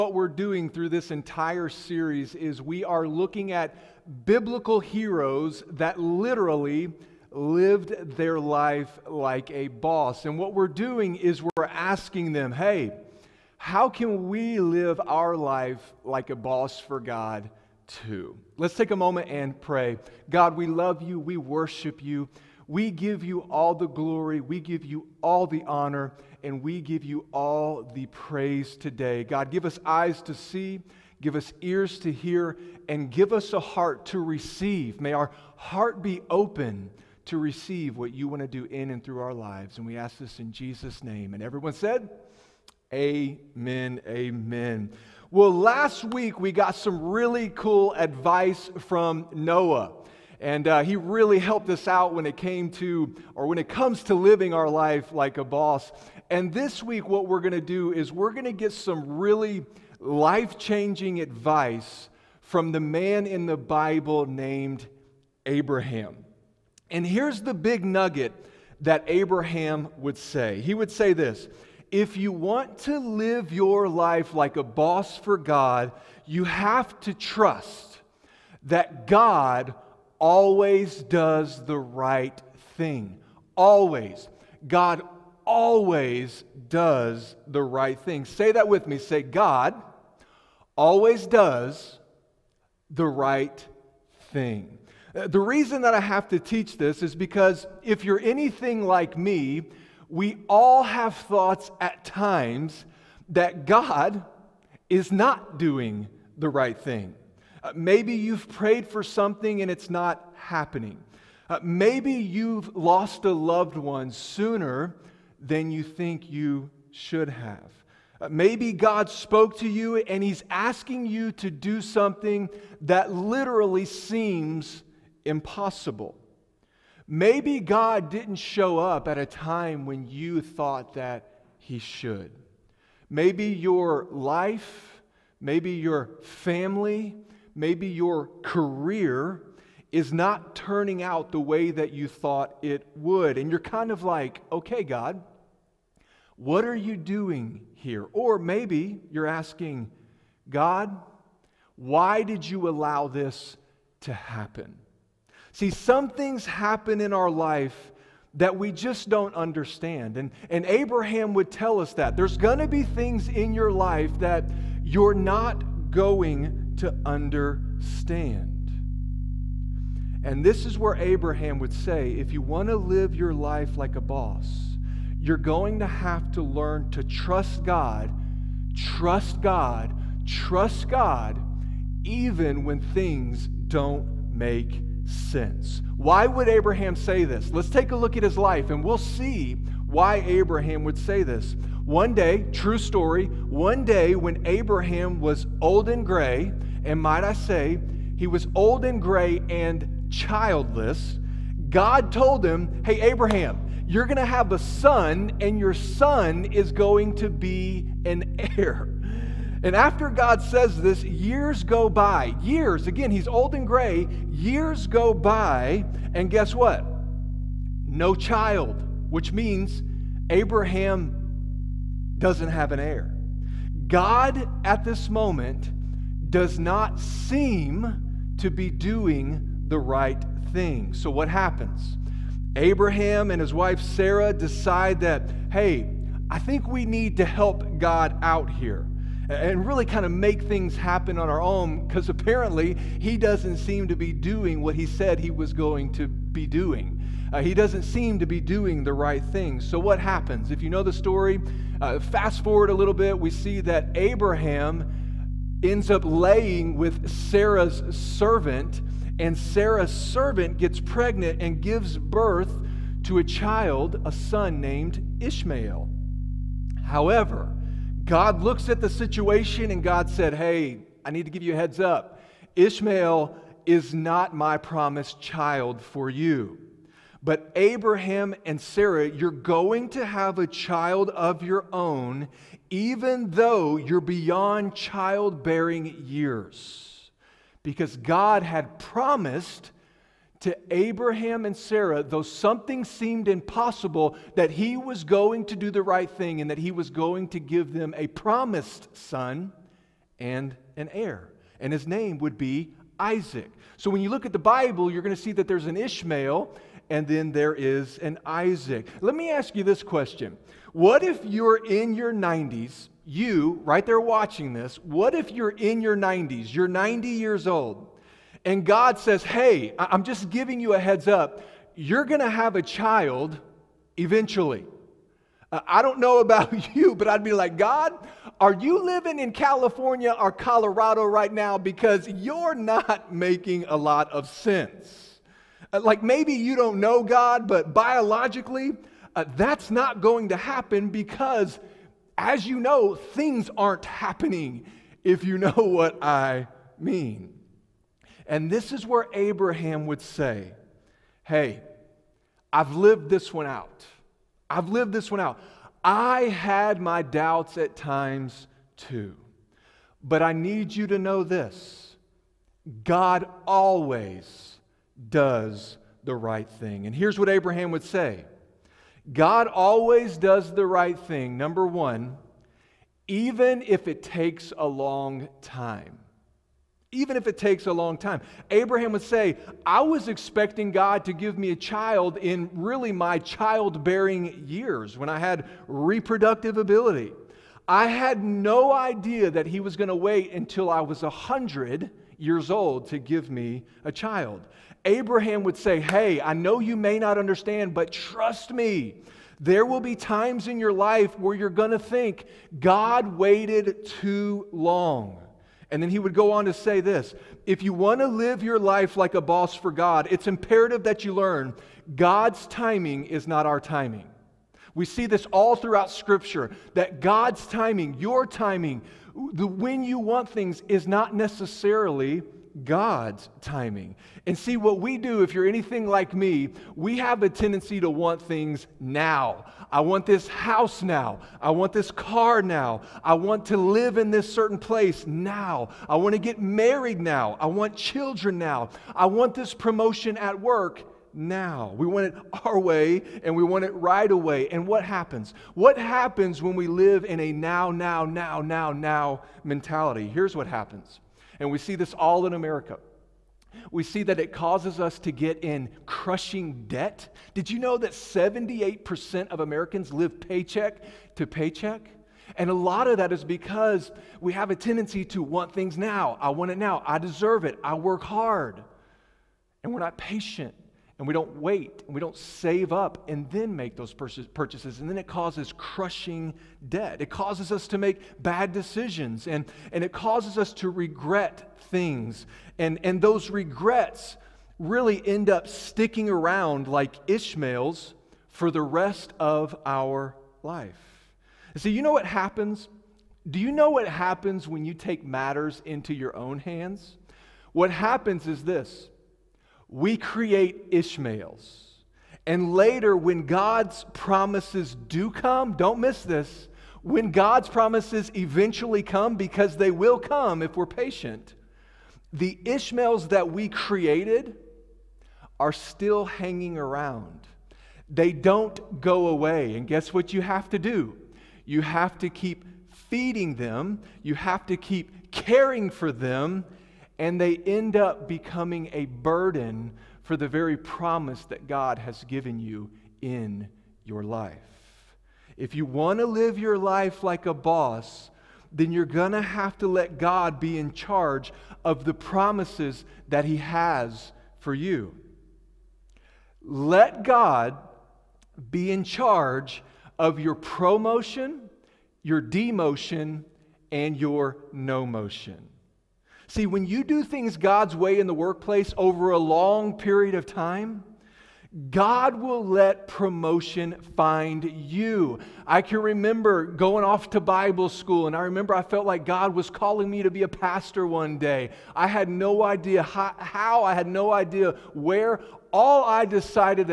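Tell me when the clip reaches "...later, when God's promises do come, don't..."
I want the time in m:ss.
8:22.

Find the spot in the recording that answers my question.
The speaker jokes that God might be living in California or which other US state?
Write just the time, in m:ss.
5:30.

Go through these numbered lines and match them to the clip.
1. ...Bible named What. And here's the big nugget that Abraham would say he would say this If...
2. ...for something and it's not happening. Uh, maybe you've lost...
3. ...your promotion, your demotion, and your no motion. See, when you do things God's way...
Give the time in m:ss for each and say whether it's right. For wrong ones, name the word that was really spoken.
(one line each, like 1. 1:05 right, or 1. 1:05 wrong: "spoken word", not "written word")
1. 1:03 wrong: "Abraham", not "What"
2. 1:48 right
3. 9:10 right.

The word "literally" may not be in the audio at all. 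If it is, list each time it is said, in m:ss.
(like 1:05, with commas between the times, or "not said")
0:05, 2:03.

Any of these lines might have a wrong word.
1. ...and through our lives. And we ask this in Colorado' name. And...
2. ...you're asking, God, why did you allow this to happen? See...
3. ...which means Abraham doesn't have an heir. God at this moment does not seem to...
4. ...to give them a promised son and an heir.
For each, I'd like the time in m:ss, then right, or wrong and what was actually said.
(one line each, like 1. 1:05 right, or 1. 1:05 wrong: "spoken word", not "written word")
1. 0:38 wrong: "Jesus", not "Colorado"
2. 2:29 right
3. 3:39 right
4. 4:57 right.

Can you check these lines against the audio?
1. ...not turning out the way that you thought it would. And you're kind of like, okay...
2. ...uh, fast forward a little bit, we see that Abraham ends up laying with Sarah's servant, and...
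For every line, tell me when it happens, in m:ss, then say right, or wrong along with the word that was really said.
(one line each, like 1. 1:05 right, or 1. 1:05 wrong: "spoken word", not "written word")
1. 2:20 right
2. 4:11 right.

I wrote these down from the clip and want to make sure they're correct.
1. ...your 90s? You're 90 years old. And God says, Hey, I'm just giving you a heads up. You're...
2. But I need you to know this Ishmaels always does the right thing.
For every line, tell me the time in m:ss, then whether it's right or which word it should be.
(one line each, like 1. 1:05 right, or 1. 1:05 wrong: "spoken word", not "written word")
1. 5:15 right
2. 6:00 wrong: "God", not "Ishmaels".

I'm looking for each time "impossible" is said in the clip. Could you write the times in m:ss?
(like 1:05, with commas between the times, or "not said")
2:05, 4:53.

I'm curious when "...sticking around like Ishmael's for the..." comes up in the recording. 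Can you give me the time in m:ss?
8:05.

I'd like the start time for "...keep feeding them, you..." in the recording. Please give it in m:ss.
8:42.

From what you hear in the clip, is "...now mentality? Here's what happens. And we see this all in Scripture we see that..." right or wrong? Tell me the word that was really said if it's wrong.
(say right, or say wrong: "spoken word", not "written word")
wrong: "America", not "Scripture".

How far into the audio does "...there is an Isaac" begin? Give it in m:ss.
5:07.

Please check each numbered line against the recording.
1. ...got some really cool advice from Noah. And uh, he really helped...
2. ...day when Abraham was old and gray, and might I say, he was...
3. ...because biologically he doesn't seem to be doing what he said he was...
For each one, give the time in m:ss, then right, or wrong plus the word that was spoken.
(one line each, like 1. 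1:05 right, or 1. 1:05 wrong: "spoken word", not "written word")
1. 0:46 right
2. 3:13 right
3. 4:01 wrong: "apparently", not "biologically".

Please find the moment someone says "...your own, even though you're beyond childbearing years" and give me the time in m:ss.
4:41.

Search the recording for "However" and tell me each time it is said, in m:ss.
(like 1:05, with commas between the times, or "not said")
4:26.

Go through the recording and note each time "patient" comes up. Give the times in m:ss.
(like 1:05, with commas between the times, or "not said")
7:49, 8:30.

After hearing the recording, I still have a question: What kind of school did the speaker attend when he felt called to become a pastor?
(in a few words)
Bible school.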